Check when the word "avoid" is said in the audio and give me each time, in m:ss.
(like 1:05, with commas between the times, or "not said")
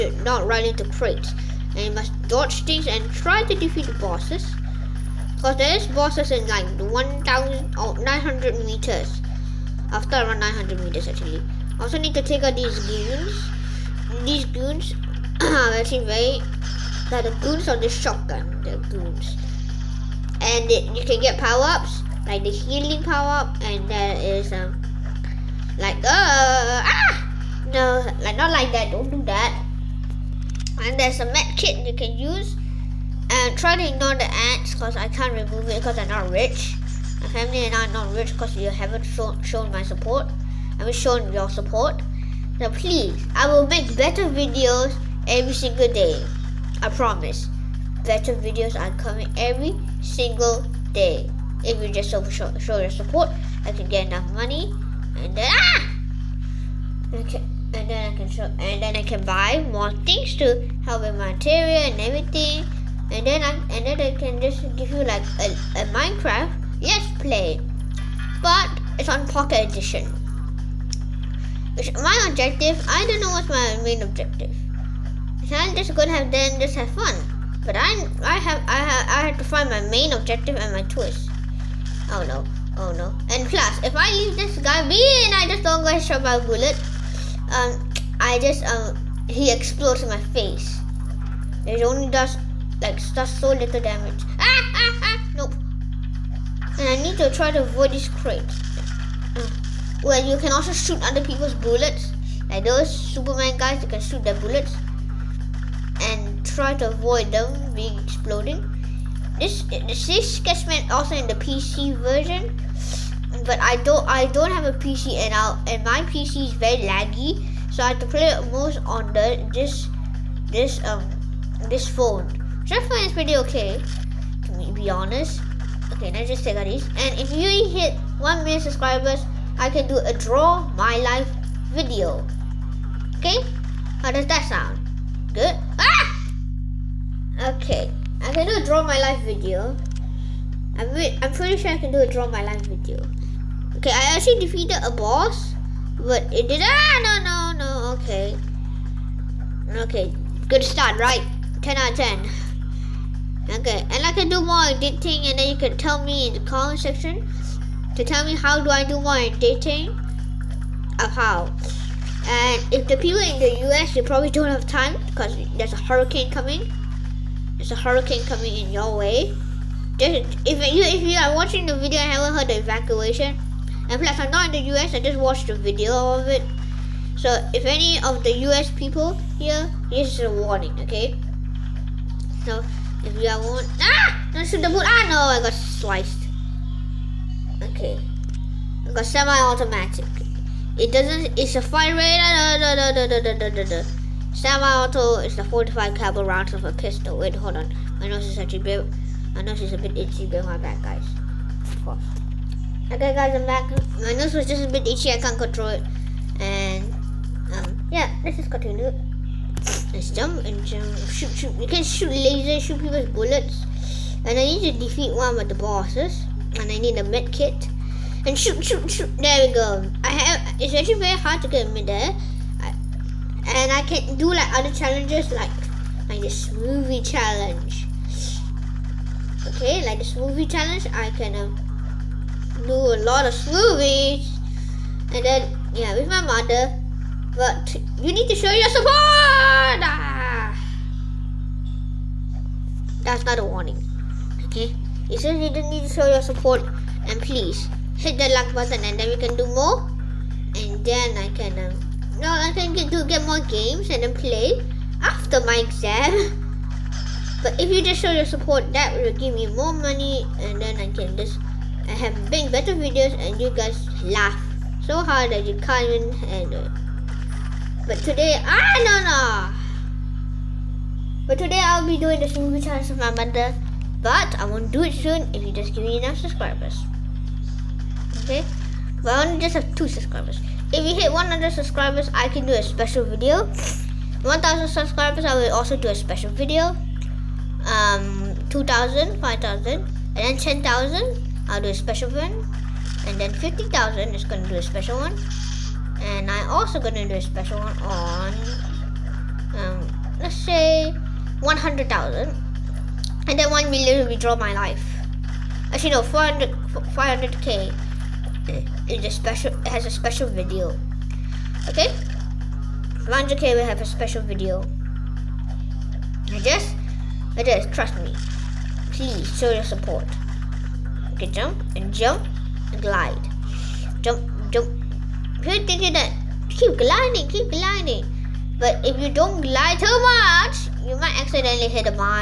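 1:37, 1:46.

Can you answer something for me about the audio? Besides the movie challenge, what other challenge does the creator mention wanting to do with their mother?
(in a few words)
smoothie challenge.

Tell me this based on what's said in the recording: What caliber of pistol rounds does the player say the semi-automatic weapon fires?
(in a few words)
45 caliber.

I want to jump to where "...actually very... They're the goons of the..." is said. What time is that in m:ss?
0:15.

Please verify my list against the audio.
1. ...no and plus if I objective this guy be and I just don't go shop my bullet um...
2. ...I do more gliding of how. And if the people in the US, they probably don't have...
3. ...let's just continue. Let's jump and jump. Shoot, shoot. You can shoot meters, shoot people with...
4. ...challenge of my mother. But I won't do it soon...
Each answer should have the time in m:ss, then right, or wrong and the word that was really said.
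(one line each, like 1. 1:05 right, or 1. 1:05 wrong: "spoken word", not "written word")
1. 1:22 wrong: "leave", not "objective"
2. 2:38 wrong: "editing", not "gliding"
3. 3:28 wrong: "lasers", not "meters"
4. 4:32 right.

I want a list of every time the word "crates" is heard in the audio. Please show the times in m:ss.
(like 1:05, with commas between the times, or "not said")
0:00, 1:38.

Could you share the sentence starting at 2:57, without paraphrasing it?
So if any of the US people here, this is a warning, okay?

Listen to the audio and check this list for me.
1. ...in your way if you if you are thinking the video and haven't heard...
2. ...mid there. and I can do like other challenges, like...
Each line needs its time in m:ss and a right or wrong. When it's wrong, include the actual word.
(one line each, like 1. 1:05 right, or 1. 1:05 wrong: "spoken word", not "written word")
1. 2:48 wrong: "watching", not "thinking"
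2. 3:41 right.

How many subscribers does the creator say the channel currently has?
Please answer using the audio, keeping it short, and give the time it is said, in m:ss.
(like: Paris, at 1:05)
2, at 4:39.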